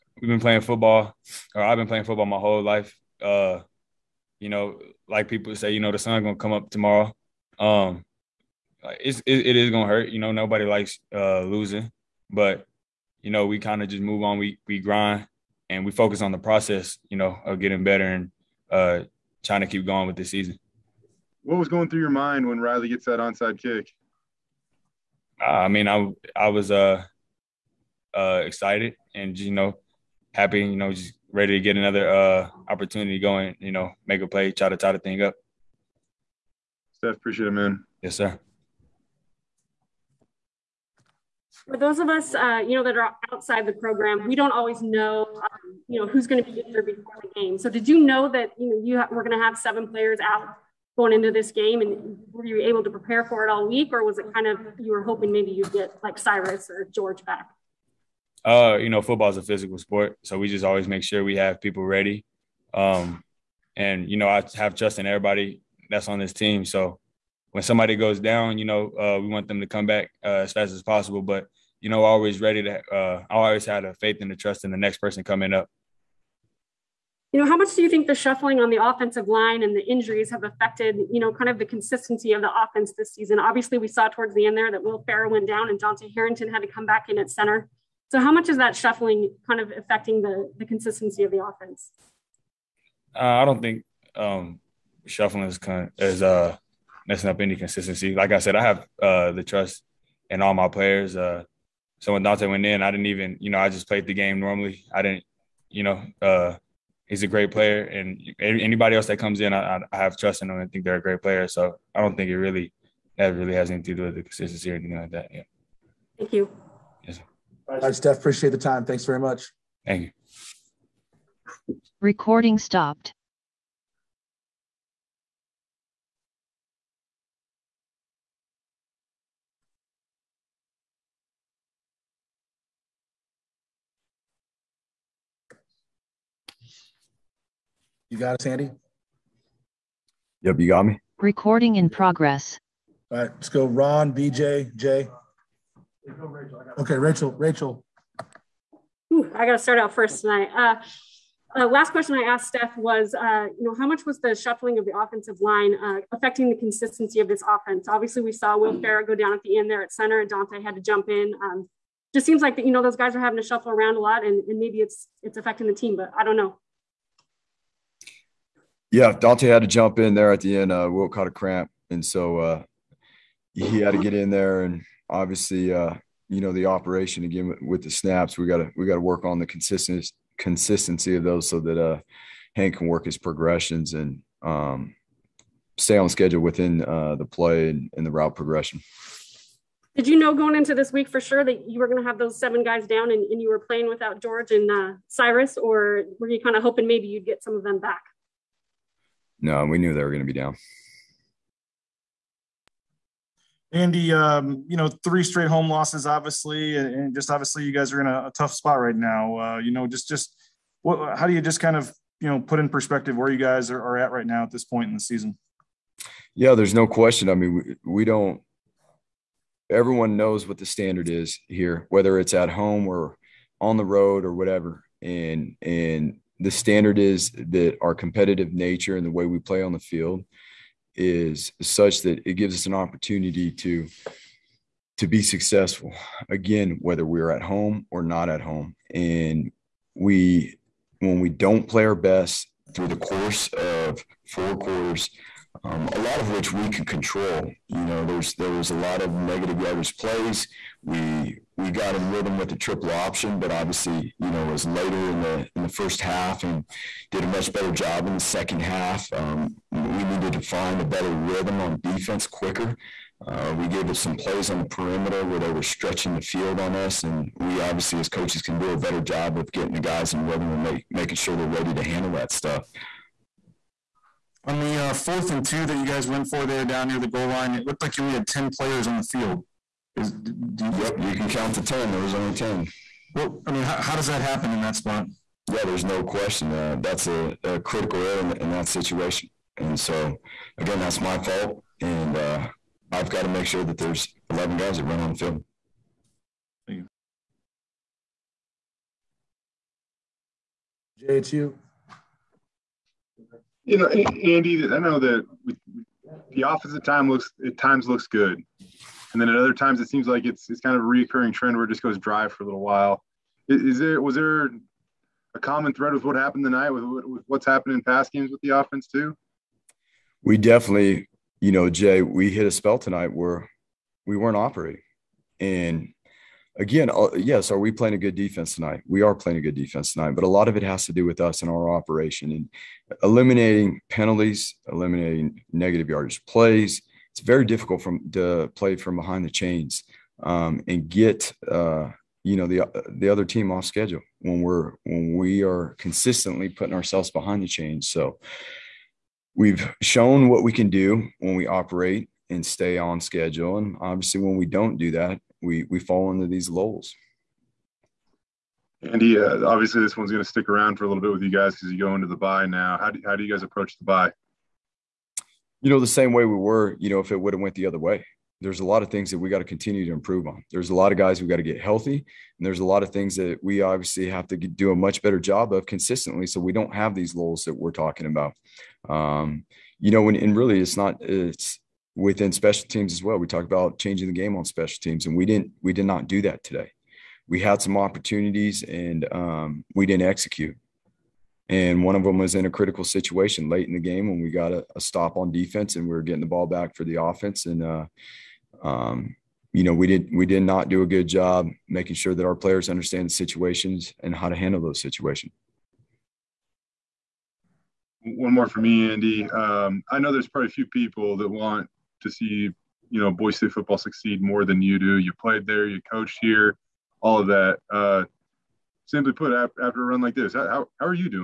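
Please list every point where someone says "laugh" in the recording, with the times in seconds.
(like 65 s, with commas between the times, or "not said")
not said.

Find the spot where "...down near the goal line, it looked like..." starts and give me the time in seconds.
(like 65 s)
276 s.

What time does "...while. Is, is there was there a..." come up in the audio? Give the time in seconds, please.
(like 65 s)
312 s.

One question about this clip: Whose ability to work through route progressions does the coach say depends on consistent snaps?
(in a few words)
Hank.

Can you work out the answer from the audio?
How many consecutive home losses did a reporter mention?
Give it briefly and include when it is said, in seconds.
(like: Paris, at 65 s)
3, at 204 s.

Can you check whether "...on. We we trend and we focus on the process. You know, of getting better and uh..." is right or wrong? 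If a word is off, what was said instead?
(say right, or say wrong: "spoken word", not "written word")
wrong: "grind", not "trend".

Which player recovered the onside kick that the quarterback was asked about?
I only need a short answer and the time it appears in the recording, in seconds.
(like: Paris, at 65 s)
Riley, at 22 s.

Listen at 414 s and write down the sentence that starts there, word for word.
You played there, you coached here, all of that.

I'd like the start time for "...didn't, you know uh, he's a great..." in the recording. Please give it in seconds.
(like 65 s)
105 s.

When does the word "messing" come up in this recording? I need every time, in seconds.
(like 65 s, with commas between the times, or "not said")
97 s.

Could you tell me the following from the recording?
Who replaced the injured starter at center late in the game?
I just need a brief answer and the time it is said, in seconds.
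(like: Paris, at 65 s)
Dante Harrington, at 85 s.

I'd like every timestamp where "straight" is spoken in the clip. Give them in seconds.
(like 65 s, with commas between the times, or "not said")
205 s.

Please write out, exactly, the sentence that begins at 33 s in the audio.
You know, make a play, try to tie the thing up.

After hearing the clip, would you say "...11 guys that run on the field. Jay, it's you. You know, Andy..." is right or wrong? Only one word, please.
right.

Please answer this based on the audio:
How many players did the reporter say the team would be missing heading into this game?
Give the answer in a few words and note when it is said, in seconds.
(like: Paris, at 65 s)
7, at 49 s.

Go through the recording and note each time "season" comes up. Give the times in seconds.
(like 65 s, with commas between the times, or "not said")
20 s, 83 s, 214 s.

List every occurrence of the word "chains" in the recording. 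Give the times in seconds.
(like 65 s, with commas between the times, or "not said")
339 s, 347 s.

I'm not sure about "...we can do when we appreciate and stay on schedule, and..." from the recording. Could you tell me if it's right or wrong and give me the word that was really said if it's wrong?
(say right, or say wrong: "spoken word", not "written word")
wrong: "operate", not "appreciate".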